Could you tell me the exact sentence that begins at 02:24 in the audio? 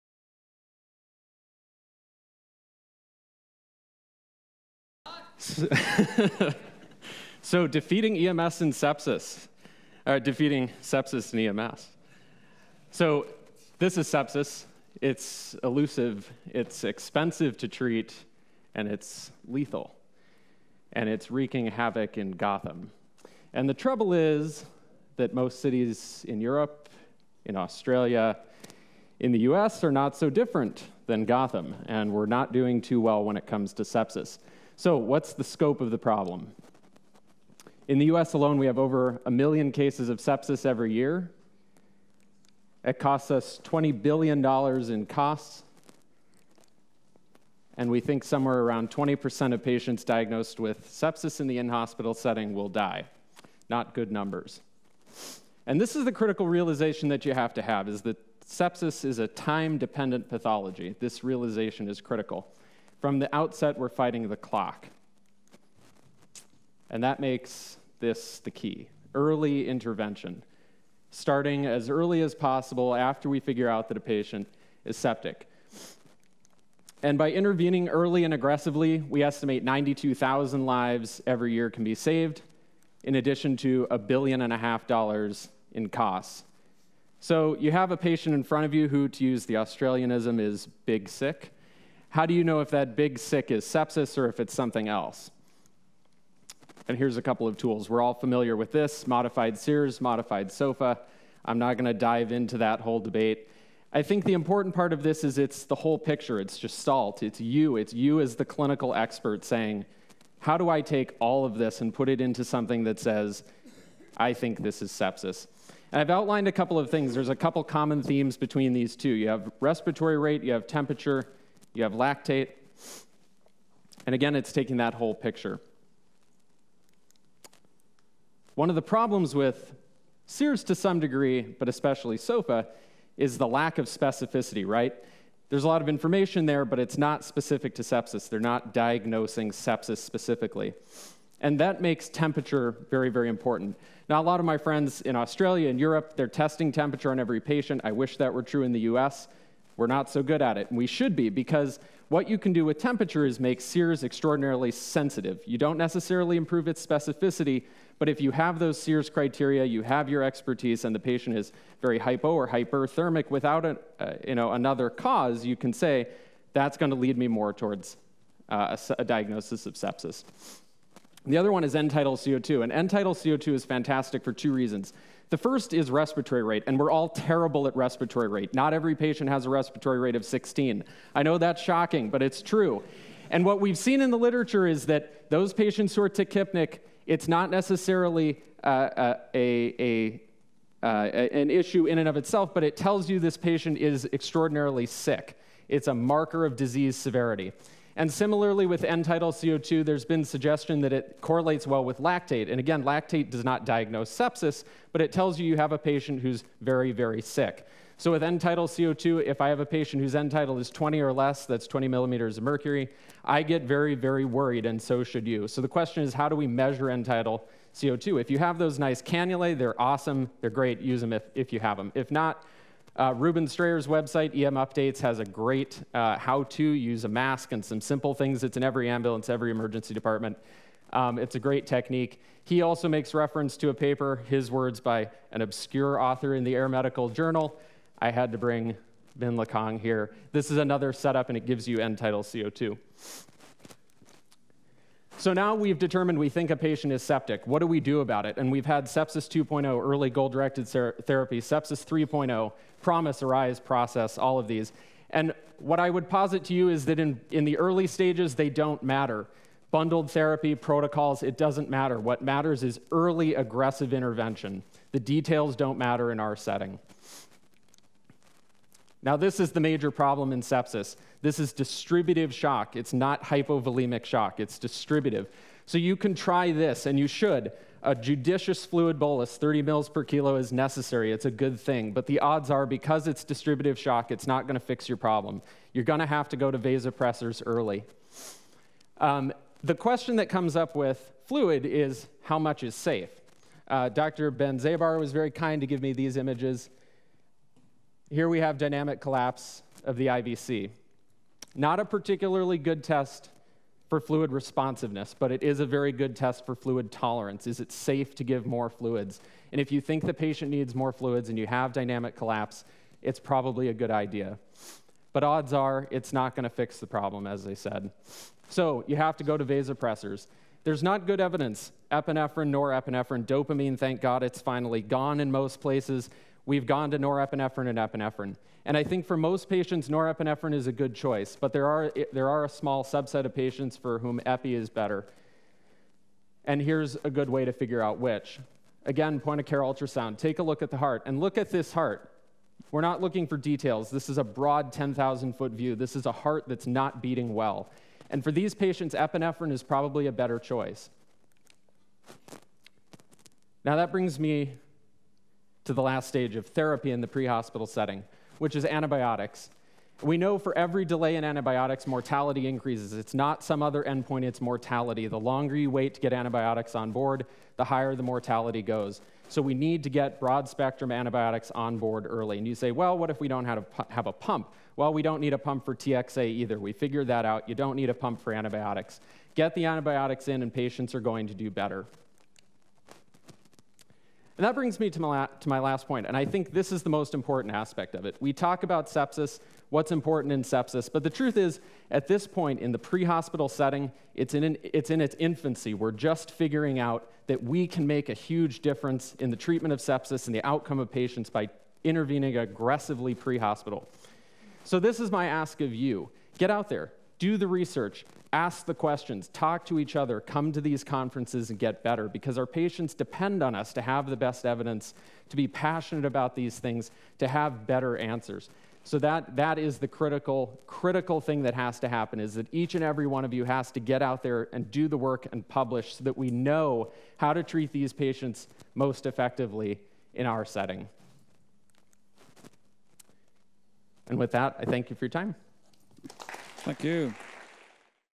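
Now, a lot of my friends in Australia and Europe, they're testing temperature on every patient.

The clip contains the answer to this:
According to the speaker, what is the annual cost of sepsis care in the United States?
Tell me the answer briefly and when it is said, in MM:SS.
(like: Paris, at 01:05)
$20 billion, at 00:43.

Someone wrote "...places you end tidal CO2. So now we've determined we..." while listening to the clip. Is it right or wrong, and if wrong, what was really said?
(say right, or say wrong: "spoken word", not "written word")
wrong: "gives", not "places".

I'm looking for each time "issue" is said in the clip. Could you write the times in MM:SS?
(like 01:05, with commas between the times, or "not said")
03:11.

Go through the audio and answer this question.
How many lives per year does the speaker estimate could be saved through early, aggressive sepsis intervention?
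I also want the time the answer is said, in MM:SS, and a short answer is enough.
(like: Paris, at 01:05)
92,000, at 01:19.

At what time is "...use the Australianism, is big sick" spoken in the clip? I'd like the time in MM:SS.
01:29.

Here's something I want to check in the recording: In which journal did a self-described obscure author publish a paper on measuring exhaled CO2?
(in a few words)
Air Medical Journal.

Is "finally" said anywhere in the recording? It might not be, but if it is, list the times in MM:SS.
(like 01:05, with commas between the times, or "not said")
05:24.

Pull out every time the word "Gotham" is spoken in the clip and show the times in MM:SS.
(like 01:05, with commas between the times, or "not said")
00:22, 00:31.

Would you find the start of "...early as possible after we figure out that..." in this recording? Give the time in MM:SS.
01:11.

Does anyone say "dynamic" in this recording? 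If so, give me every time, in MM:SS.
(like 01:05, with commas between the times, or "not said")
04:58, 05:11.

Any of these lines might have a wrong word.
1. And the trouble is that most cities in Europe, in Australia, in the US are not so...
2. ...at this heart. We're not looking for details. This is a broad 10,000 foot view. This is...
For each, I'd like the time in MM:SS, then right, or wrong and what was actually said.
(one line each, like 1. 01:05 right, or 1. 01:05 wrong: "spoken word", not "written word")
1. 00:23 right
2. 05:41 right.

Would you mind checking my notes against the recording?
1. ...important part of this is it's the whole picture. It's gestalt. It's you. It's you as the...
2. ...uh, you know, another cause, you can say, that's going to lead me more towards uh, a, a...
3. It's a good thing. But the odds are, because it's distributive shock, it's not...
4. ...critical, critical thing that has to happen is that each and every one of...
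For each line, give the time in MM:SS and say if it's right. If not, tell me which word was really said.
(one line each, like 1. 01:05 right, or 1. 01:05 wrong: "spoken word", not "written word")
1. 01:44 right
2. 02:43 right
3. 04:41 right
4. 06:59 right.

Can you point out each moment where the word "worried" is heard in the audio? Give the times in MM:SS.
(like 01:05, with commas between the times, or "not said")
03:34.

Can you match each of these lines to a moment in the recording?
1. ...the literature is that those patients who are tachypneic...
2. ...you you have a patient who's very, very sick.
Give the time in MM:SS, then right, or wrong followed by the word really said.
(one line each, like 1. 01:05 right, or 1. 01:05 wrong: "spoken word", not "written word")
1. 03:04 right
2. 03:25 right.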